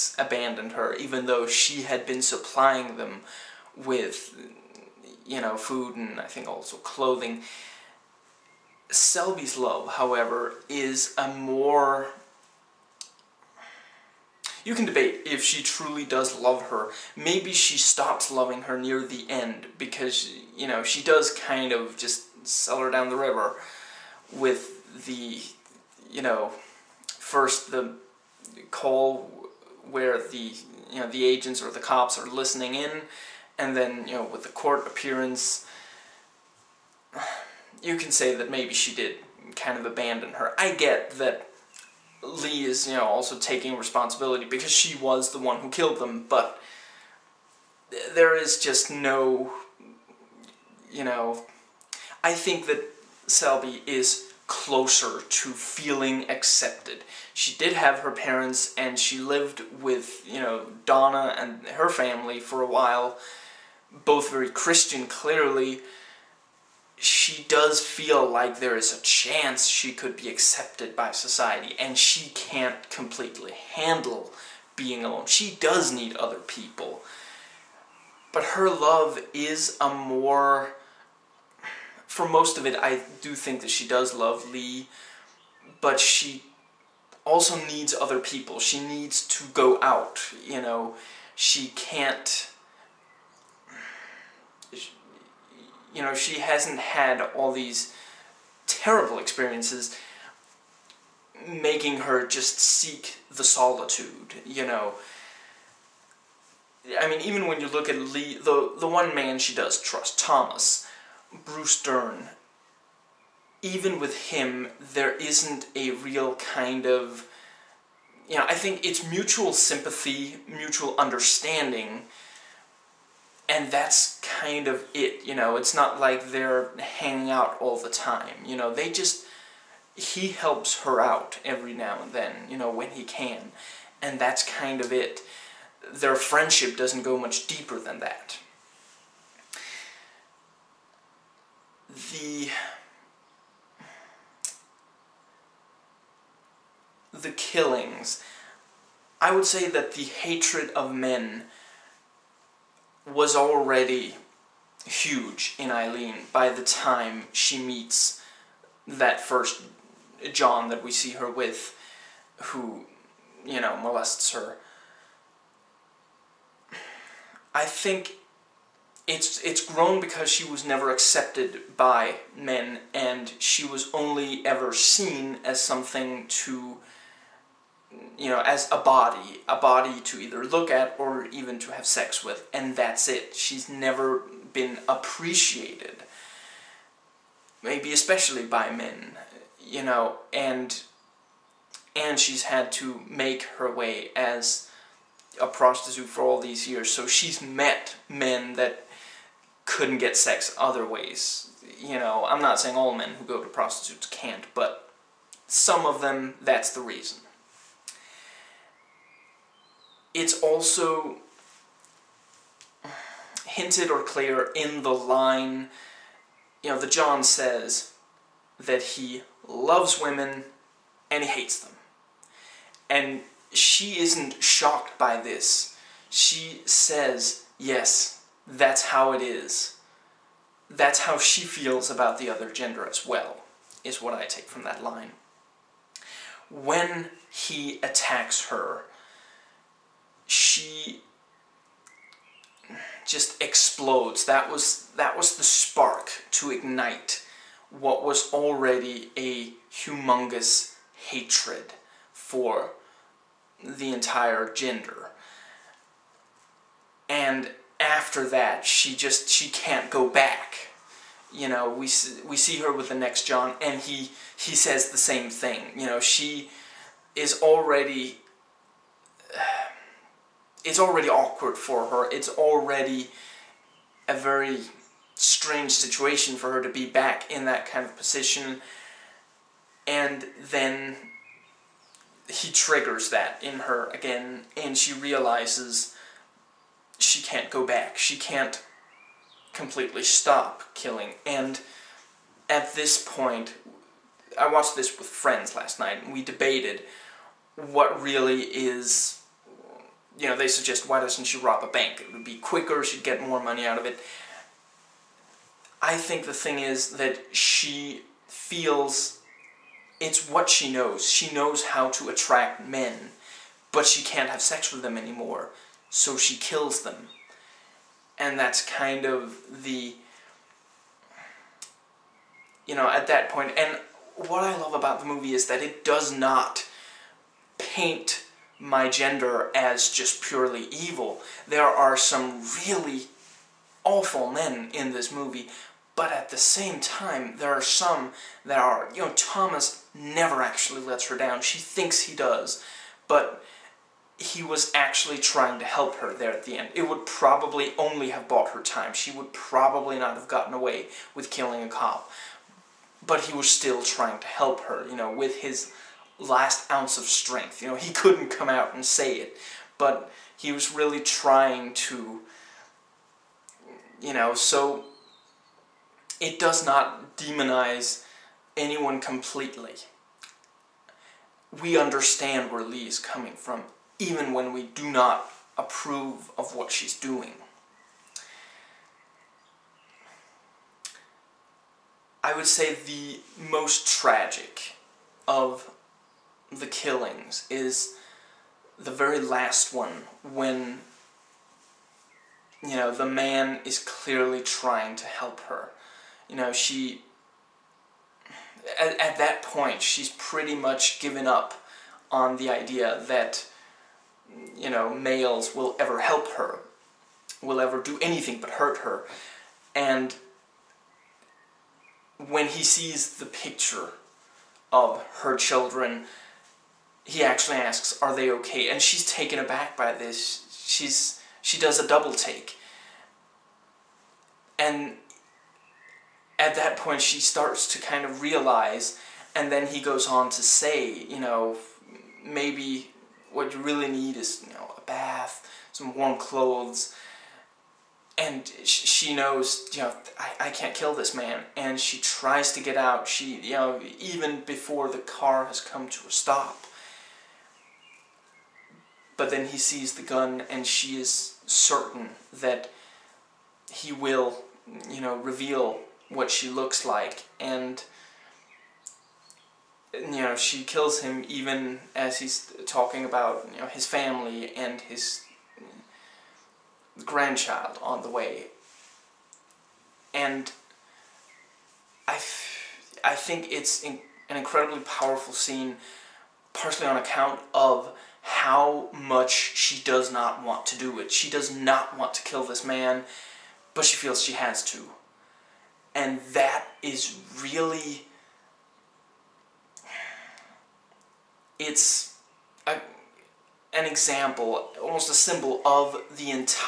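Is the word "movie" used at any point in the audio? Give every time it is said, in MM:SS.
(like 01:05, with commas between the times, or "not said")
05:25, 05:35.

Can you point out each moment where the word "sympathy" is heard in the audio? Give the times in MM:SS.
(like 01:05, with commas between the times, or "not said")
01:59.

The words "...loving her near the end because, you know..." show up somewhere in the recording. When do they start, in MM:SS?
00:18.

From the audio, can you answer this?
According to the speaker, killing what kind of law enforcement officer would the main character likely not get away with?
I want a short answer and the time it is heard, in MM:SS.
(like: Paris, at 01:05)
a cop, at 05:51.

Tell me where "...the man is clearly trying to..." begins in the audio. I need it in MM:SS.
06:32.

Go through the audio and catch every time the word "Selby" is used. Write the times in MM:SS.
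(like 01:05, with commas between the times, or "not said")
00:08, 00:53.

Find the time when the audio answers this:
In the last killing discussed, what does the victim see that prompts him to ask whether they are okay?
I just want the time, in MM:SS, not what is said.
06:53.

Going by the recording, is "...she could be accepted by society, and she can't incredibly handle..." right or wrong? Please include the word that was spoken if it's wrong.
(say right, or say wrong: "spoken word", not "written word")
wrong: "completely", not "incredibly".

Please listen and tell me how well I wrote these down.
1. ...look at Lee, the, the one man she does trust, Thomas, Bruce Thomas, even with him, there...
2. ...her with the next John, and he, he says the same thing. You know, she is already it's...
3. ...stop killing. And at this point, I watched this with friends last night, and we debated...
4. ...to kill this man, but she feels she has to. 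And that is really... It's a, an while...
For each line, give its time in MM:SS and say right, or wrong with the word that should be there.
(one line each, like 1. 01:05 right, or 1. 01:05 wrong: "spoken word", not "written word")
1. 01:47 wrong: "Dern", not "Thomas"
2. 04:22 right
3. 04:50 right
4. 08:02 wrong: "example", not "while".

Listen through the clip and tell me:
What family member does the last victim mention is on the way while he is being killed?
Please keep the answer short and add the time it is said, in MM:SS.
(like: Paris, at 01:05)
his grandchild, at 07:47.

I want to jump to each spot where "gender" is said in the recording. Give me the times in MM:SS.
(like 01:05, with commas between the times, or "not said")
03:52, 04:14, 05:28.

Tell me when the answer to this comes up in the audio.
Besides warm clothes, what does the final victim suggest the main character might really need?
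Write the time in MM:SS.
07:14.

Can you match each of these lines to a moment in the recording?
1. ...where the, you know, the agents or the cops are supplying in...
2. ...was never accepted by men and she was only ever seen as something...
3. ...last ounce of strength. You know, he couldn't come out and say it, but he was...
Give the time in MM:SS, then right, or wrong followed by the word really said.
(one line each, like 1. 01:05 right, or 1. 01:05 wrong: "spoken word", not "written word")
1. 00:29 wrong: "listening", not "supplying"
2. 02:50 right
3. 05:56 right.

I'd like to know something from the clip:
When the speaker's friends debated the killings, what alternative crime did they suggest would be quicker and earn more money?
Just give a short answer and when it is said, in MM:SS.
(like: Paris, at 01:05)
rob a bank, at 05:01.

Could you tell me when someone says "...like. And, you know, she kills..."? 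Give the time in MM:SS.
07:36.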